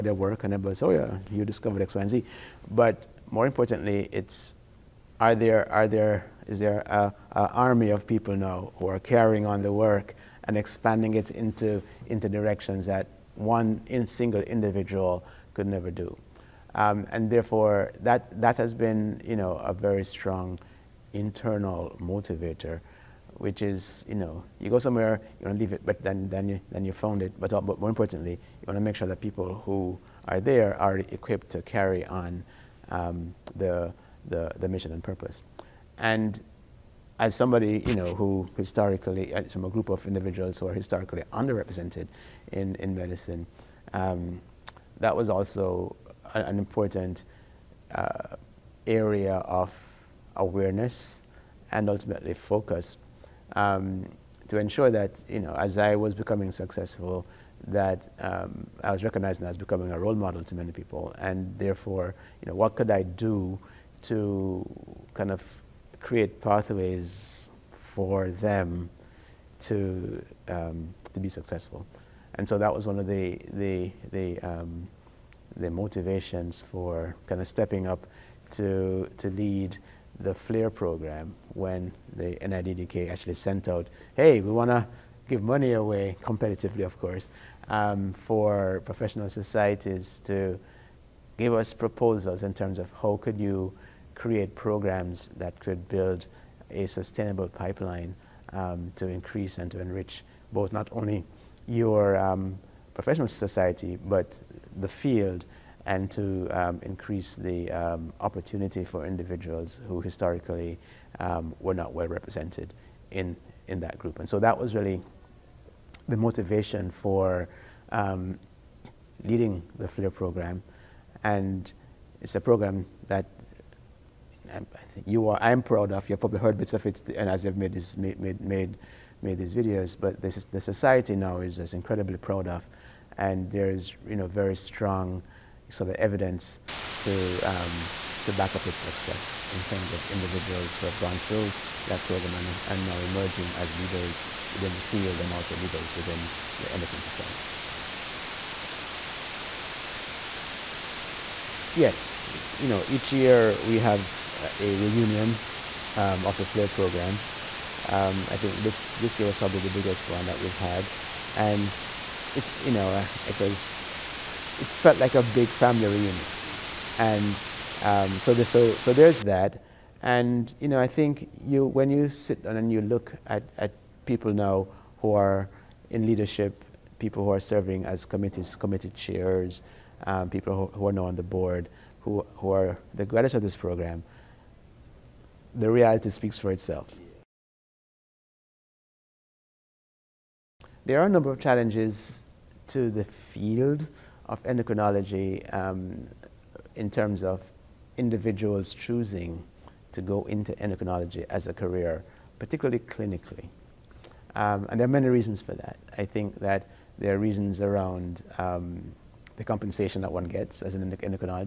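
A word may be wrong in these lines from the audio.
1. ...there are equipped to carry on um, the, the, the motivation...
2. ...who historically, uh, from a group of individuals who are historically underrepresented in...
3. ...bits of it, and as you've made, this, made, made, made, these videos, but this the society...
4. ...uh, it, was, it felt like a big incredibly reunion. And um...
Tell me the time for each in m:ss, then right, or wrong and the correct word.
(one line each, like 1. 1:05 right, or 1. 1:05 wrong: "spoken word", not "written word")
1. 0:30 wrong: "mission", not "motivation"
2. 0:38 right
3. 2:06 right
4. 2:42 wrong: "family", not "incredibly".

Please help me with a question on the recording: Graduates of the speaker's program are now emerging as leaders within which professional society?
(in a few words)
Endocrine Society.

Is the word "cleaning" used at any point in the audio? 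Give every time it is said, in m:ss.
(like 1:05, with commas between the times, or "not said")
not said.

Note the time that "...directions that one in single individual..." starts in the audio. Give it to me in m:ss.
0:12.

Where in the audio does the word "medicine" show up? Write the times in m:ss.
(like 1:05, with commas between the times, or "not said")
0:42.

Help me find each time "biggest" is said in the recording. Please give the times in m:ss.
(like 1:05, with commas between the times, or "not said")
2:39.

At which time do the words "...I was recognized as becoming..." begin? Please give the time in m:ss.
0:58.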